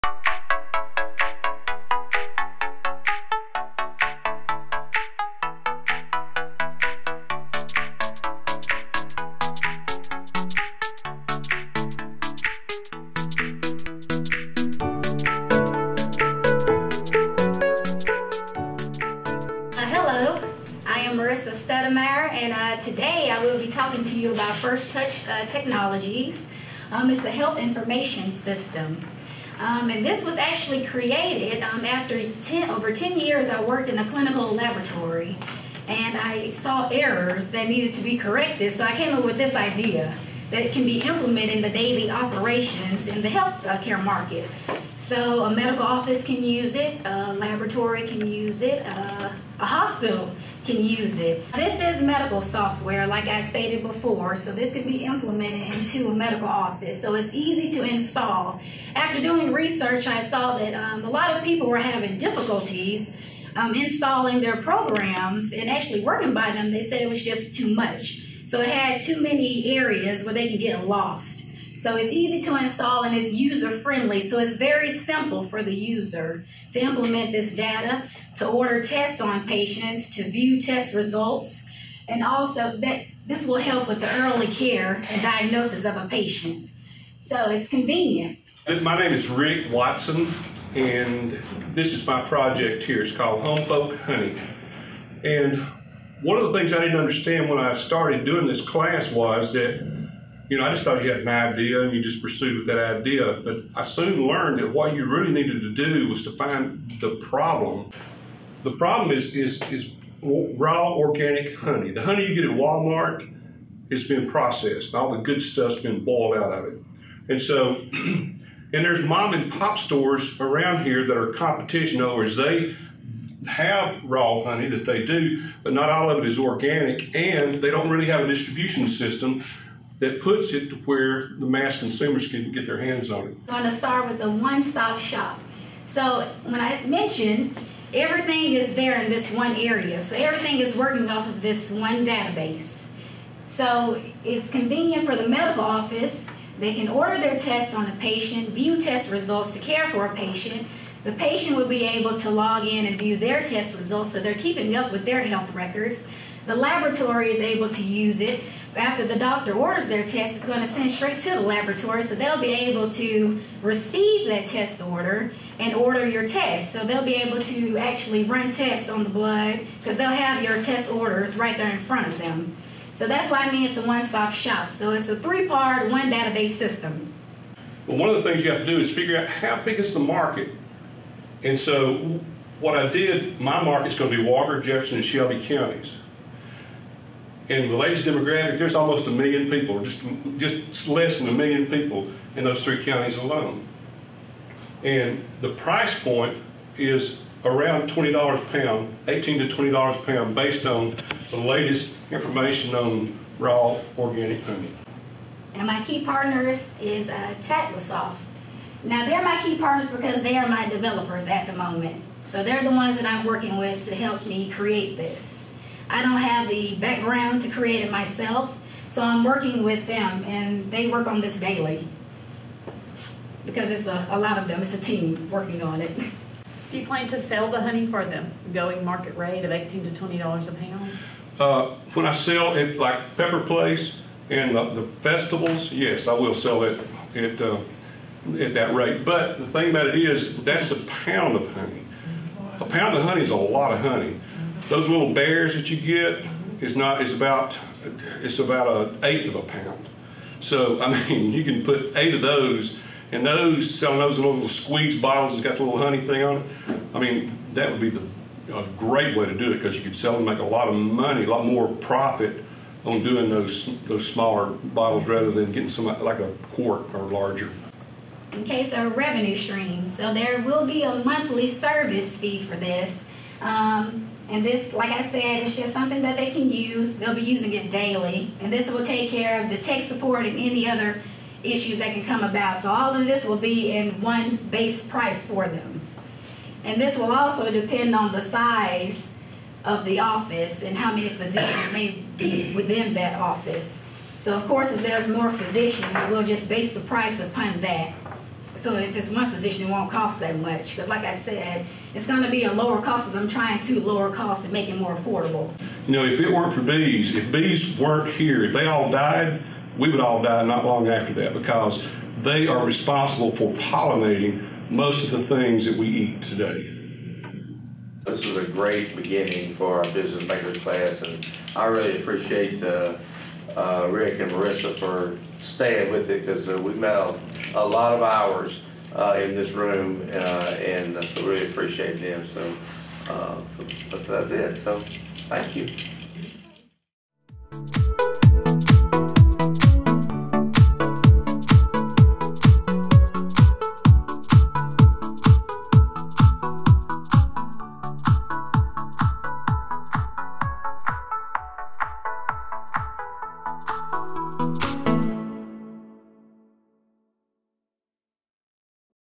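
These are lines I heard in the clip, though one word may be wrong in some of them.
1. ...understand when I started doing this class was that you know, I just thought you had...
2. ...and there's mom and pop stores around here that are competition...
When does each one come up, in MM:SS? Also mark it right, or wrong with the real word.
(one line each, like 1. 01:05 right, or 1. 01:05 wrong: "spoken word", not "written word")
1. 01:36 right
2. 01:57 right.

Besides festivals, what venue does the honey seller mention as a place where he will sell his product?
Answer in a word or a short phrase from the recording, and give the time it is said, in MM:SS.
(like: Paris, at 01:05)
Pepper Place, at 03:53.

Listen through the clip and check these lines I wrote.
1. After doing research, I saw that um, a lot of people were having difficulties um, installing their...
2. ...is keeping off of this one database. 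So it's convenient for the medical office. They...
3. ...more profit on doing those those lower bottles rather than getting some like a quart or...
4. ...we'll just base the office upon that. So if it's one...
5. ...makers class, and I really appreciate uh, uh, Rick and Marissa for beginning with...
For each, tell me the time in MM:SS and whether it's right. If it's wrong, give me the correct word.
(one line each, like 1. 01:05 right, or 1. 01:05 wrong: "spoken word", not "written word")
1. 00:58 right
2. 02:20 wrong: "working", not "keeping"
3. 04:21 wrong: "smaller", not "lower"
4. 04:56 wrong: "price", not "office"
5. 05:20 wrong: "staying", not "beginning".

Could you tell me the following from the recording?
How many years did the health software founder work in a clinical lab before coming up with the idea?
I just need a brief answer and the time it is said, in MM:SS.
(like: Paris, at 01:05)
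10, at 00:32.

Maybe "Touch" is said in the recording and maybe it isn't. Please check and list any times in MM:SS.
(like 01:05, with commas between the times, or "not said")
00:24.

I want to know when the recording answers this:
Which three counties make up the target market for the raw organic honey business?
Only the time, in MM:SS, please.
03:04.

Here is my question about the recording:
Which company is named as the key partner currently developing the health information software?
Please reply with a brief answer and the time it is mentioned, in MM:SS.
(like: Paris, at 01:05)
TatvaSoft, at 03:27.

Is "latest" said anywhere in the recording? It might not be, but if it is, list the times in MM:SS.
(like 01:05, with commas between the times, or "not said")
03:07, 03:21.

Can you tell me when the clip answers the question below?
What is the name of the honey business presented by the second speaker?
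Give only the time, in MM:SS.
01:33.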